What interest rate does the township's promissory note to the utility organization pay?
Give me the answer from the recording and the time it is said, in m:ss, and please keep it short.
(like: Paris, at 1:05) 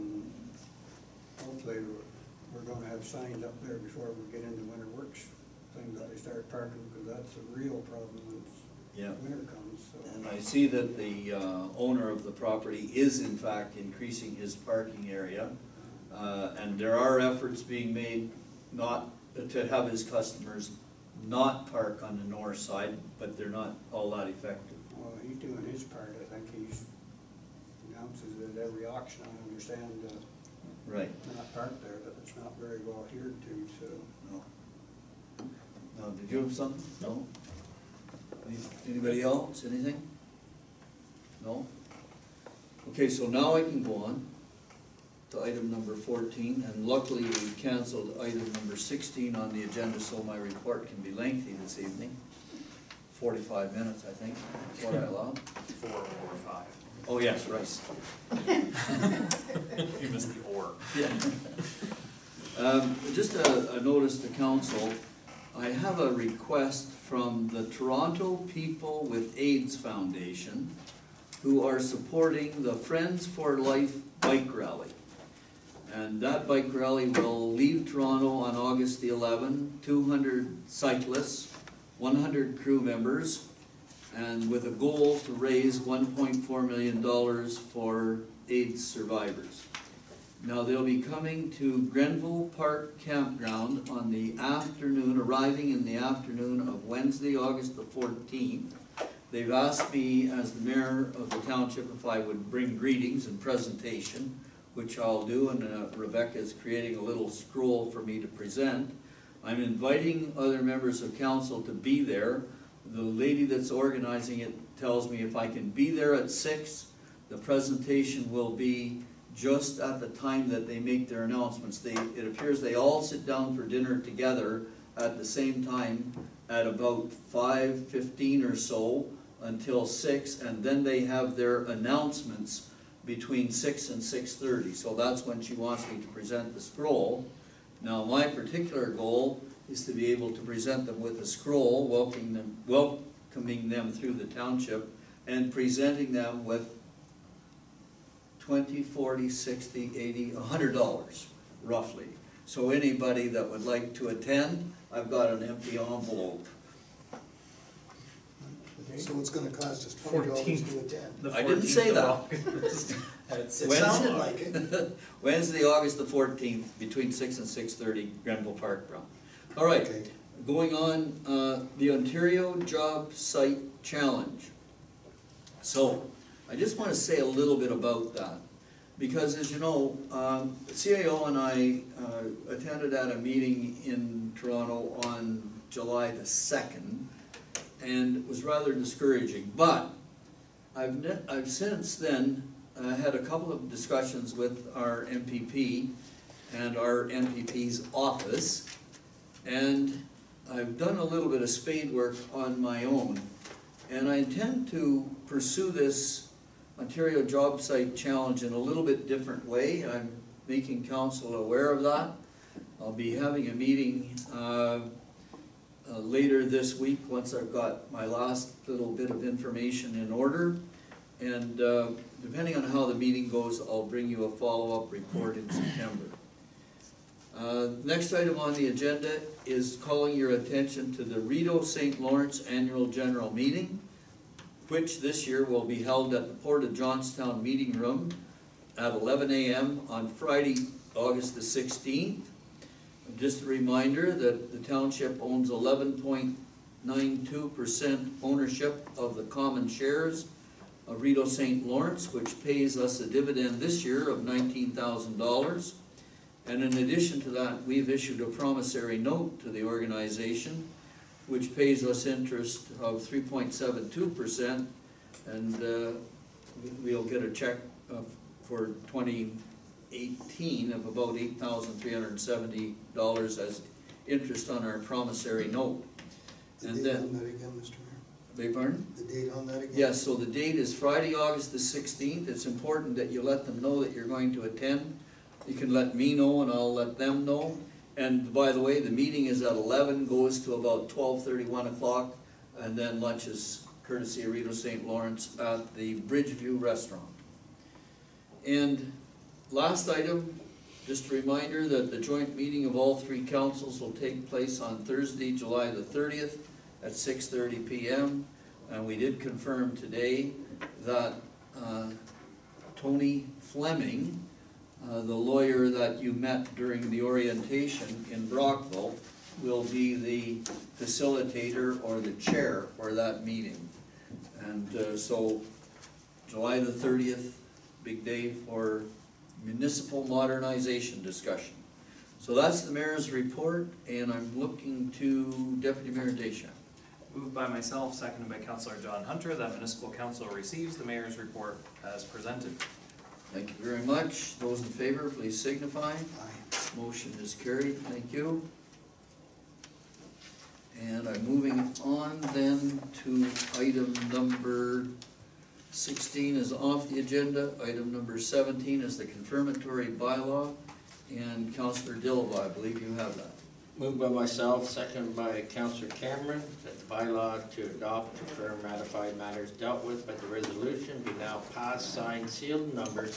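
3.72%, at 4:23.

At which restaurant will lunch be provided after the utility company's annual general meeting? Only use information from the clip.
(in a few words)
Bridgeview Restaurant.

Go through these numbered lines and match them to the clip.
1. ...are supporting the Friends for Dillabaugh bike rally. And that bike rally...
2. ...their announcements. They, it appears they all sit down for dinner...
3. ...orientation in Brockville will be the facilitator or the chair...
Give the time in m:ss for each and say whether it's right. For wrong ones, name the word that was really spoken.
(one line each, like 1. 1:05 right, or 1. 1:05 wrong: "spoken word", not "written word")
1. 1:11 wrong: "Life", not "Dillabaugh"
2. 2:01 right
3. 5:17 right.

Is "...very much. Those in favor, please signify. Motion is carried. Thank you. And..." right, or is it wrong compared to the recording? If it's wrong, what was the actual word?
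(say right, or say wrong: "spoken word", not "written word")
right.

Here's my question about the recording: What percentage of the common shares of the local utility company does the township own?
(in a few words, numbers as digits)
11.92%.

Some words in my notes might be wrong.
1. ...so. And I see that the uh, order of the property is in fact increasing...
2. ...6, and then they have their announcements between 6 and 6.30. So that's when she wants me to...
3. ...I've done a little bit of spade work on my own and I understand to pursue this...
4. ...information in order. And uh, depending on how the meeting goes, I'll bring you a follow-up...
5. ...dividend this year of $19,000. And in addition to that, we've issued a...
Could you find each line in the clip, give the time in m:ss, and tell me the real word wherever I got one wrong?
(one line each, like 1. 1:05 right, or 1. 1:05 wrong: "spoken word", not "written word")
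1. 0:09 wrong: "owner", not "order"
2. 2:09 right
3. 3:20 wrong: "intend", not "understand"
4. 3:39 right
5. 4:13 right.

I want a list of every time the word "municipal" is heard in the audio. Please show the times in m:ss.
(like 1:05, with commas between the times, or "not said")
5:29, 5:39.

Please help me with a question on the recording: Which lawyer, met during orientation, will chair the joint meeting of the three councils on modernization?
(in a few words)
Tony Fleming.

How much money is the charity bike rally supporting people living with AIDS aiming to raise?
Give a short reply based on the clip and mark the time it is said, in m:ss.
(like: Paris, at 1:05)
$1.4 million, at 1:25.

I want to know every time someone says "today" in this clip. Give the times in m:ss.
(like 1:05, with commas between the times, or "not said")
5:09.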